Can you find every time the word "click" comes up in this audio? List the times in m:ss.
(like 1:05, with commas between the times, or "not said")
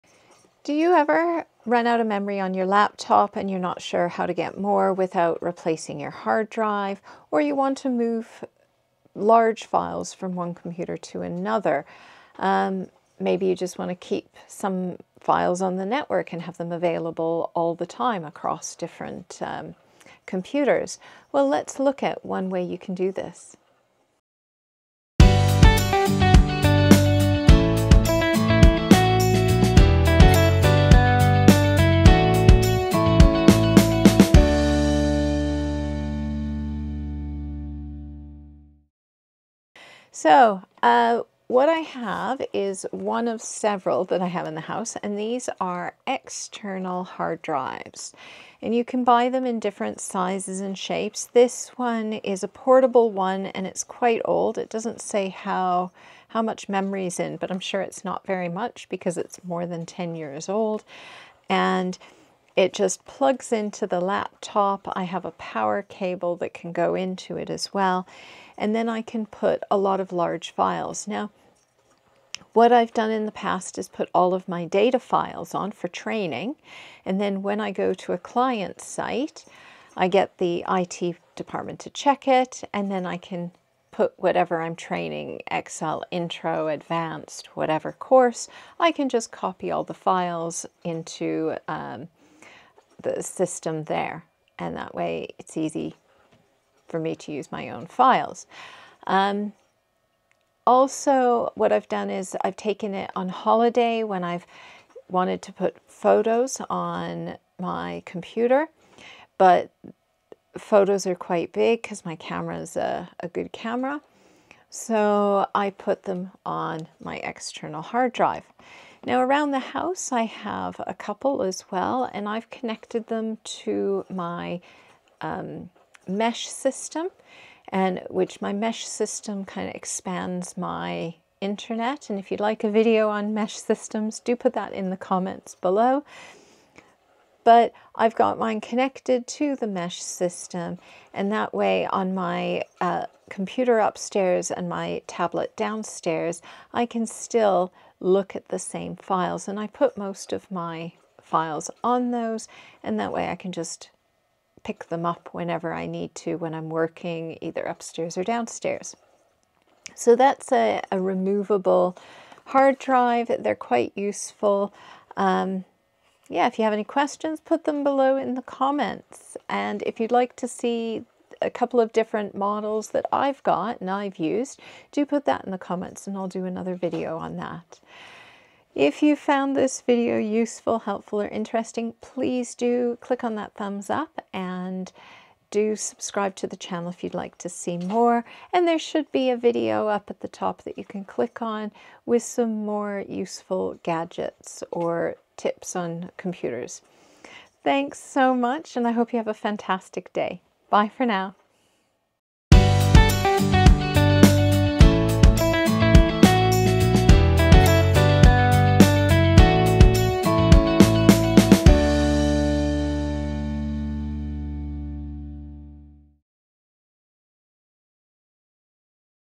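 3:03, 3:11.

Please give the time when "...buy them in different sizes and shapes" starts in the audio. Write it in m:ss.
0:49.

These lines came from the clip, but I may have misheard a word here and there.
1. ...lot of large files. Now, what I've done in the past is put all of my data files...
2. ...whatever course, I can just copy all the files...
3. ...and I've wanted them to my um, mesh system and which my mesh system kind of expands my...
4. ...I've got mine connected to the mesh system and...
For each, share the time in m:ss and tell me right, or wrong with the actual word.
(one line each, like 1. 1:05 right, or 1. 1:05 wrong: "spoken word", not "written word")
1. 1:09 right
2. 1:27 right
3. 2:02 wrong: "connected", not "wanted"
4. 2:17 right.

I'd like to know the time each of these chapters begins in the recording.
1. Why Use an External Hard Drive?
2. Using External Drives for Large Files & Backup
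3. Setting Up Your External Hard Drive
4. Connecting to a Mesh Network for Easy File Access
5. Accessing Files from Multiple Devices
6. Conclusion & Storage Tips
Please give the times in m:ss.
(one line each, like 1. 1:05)
1. 0:35
2. 1:45
3. 1:10
4. 2:30
5. 3:00
6. 3:30.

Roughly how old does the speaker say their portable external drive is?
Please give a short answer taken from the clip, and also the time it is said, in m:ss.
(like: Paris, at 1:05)
more than 10 years, at 0:59.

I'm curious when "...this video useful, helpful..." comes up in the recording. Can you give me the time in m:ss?
2:59.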